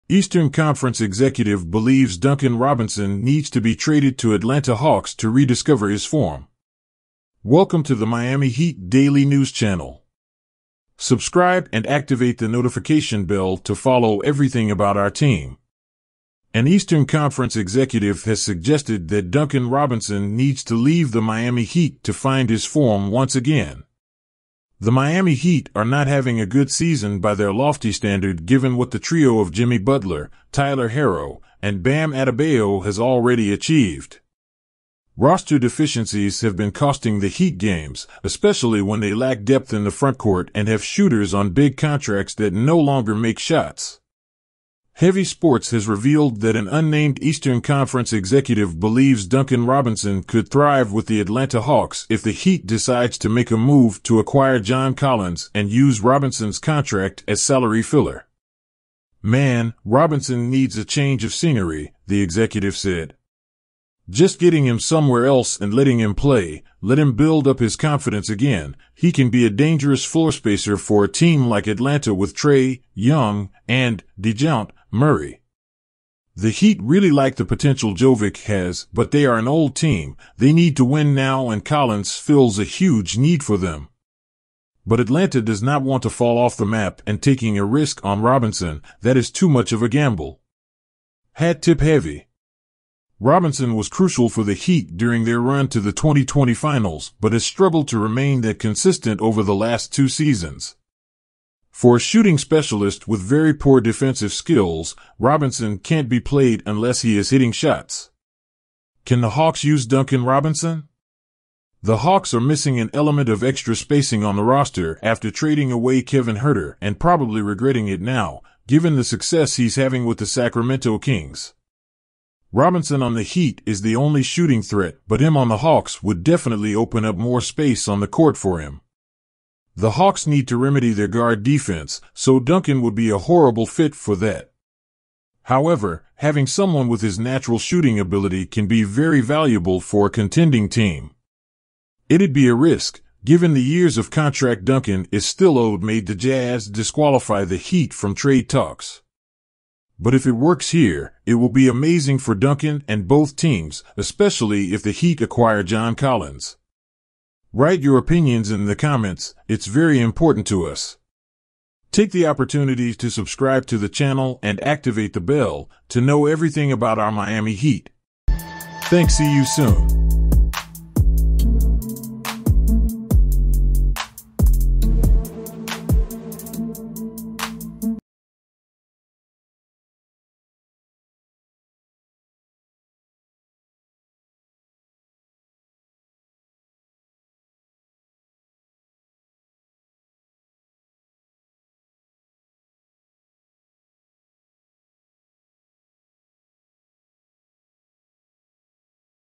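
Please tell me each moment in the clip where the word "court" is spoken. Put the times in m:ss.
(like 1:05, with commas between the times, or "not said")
0:40, 2:08.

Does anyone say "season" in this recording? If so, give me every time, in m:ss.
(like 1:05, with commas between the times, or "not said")
0:26, 1:40.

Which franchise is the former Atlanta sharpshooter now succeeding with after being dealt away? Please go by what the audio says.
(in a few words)
Sacramento Kings.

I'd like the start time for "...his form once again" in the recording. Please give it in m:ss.
0:22.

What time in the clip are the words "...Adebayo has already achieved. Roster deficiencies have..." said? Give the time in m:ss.
0:32.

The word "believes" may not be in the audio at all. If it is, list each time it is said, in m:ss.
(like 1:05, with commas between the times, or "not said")
0:01, 0:48.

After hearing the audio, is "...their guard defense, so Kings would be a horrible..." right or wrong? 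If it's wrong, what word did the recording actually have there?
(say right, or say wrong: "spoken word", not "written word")
wrong: "Duncan", not "Kings".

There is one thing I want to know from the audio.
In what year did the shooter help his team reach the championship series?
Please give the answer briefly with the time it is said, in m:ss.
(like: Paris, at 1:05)
2020, at 1:35.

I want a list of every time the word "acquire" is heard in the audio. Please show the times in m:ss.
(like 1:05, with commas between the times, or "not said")
0:54, 2:35.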